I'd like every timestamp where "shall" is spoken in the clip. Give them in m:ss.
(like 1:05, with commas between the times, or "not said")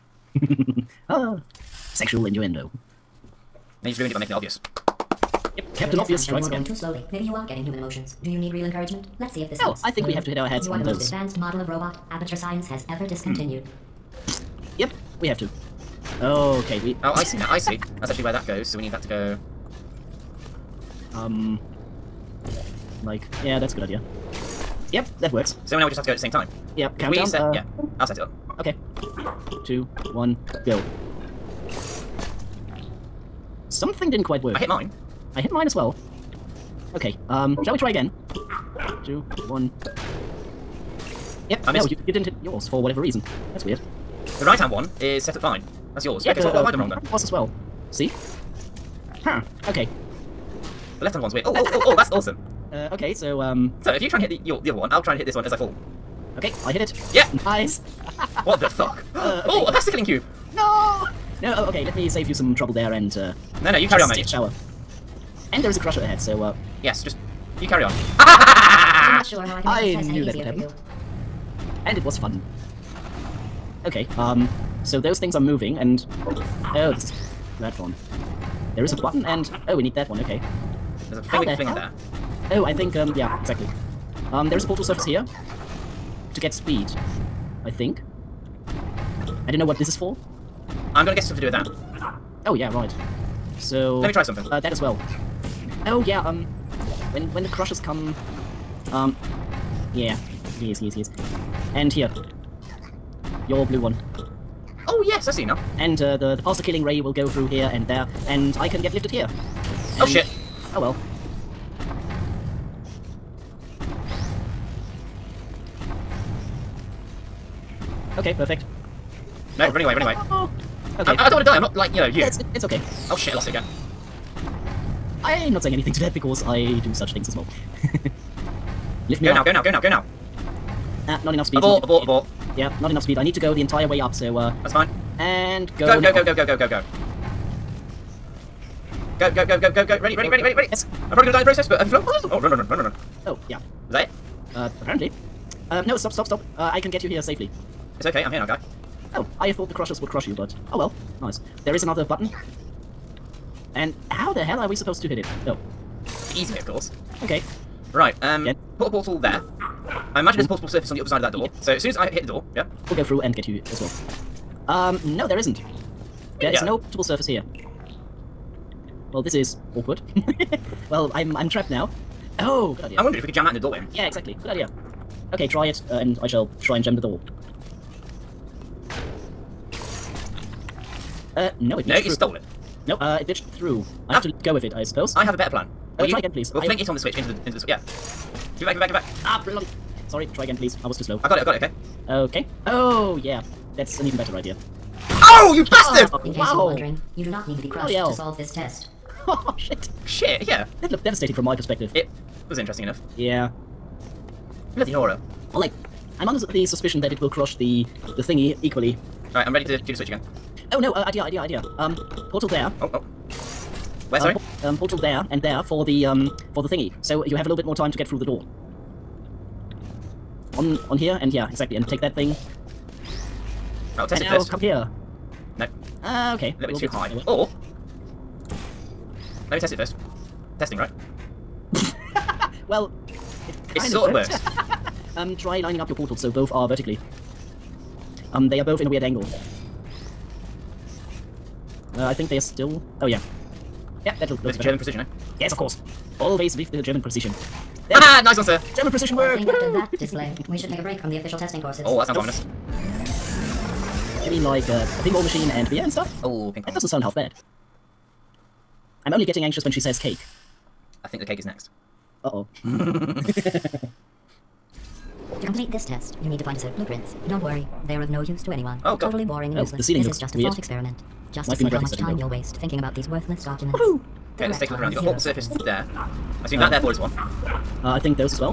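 0:37, 2:56.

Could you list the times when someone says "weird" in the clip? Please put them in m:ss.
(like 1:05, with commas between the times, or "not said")
0:43, 0:51, 3:58, 4:30.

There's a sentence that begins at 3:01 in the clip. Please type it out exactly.
Uh, no, it glitched No, you through.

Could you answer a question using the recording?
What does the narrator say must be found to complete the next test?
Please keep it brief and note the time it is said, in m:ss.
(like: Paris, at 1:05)
a set of blueprints, at 4:26.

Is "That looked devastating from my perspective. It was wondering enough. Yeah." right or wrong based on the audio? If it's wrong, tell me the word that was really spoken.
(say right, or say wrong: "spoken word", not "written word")
wrong: "interesting", not "wondering".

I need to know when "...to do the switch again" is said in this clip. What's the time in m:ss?
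3:29.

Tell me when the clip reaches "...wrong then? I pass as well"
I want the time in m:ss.
0:46.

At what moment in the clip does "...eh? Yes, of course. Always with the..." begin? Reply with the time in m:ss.
4:04.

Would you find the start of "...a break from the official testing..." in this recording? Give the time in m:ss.
4:10.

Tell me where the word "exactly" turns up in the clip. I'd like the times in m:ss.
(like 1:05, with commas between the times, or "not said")
1:23, 2:54, 3:41.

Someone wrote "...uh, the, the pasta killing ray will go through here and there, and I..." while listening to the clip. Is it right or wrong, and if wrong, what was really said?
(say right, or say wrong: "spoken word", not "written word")
right.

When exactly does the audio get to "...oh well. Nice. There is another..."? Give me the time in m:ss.
2:30.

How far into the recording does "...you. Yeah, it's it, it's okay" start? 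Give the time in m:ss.
2:02.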